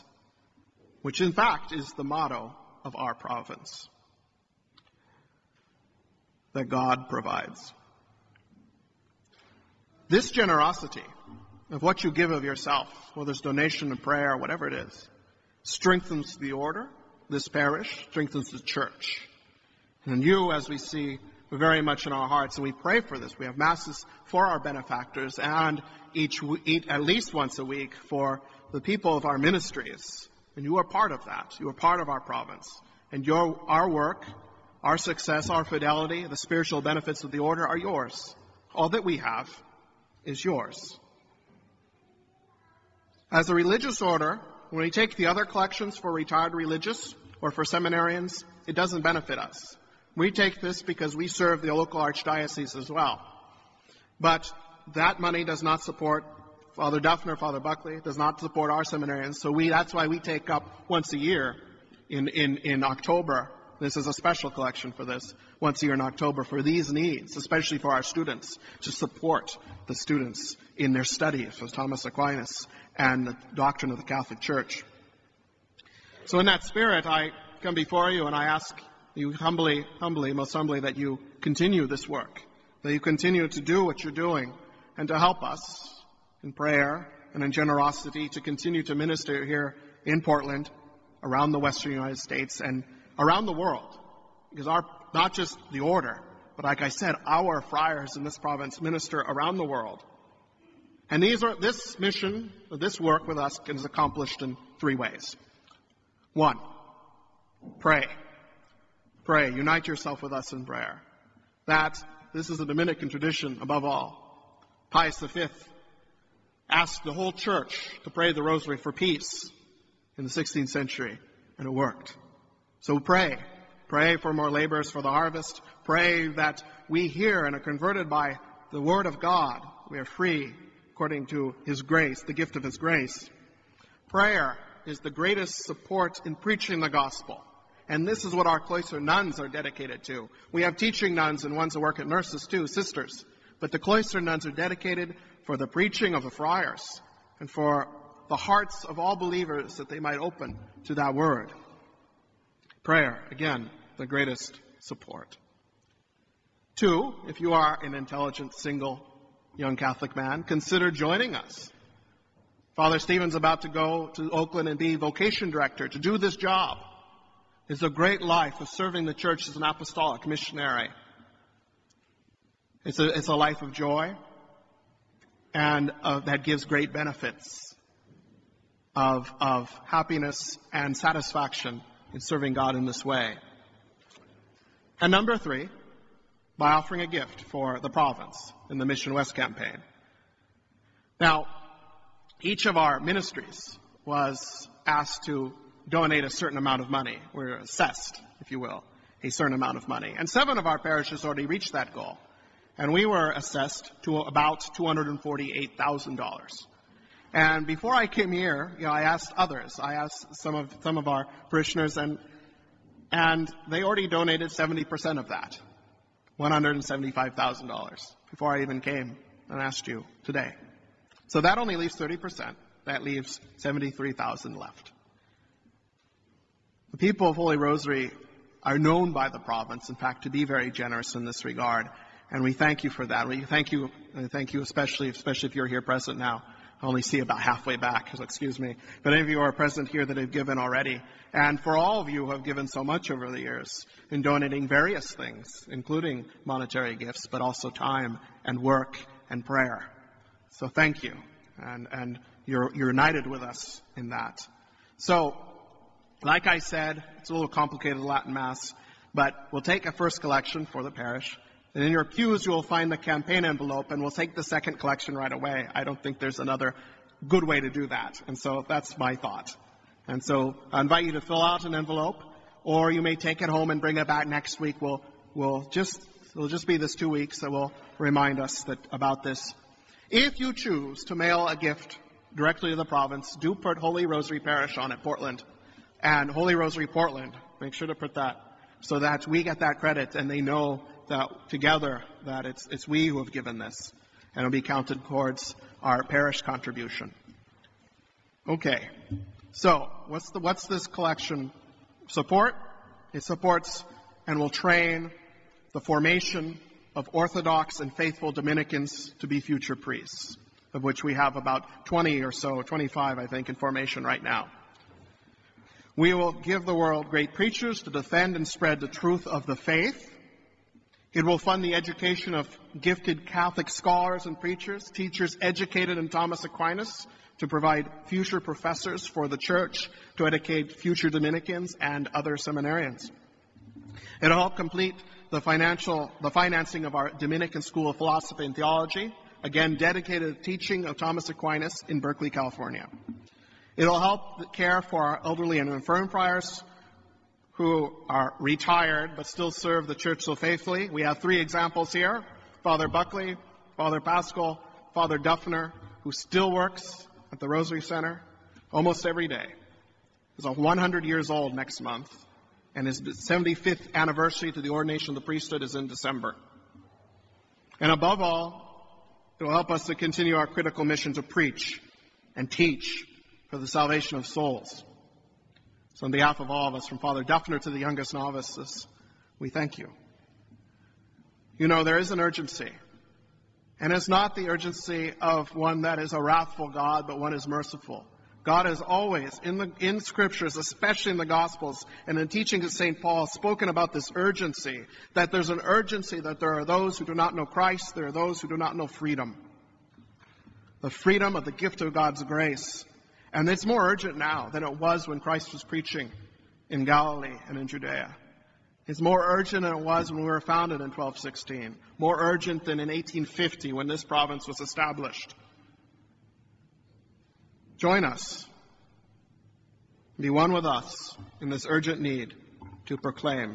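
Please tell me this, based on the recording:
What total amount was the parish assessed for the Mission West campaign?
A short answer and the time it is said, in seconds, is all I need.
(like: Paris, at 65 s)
$248,000, at 204 s.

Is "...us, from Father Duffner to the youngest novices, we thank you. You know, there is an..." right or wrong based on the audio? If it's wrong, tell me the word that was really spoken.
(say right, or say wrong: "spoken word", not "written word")
right.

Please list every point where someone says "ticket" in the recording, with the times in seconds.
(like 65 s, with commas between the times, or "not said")
not said.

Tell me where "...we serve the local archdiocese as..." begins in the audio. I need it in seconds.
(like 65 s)
51 s.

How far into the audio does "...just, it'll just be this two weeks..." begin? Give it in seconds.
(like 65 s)
275 s.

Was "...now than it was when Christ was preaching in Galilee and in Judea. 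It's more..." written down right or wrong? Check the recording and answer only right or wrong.
right.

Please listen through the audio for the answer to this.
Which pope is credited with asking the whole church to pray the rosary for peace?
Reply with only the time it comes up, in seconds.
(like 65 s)
114 s.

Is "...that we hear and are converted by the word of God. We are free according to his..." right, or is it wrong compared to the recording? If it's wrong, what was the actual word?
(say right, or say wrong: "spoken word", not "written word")
right.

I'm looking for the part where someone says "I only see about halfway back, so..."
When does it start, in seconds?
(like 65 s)
236 s.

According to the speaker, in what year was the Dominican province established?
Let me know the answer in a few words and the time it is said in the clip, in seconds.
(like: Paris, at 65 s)
1850, at 412 s.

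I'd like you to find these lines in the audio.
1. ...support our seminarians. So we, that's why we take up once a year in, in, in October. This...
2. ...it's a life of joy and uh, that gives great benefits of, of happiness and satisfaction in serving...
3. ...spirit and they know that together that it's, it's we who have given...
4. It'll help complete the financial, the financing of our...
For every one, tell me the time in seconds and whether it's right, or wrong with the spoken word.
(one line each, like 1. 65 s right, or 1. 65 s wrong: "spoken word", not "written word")
1. 58 s right
2. 173 s right
3. 289 s wrong: "credit", not "spirit"
4. 334 s right.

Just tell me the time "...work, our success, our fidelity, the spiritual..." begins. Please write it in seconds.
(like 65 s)
33 s.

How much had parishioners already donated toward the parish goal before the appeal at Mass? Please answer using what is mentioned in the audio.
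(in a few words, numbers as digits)
$175,000.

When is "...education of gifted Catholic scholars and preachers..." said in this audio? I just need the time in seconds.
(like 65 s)
321 s.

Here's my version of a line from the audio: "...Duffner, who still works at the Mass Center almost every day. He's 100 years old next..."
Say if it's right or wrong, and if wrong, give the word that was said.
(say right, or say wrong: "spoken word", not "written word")
wrong: "Rosary", not "Mass".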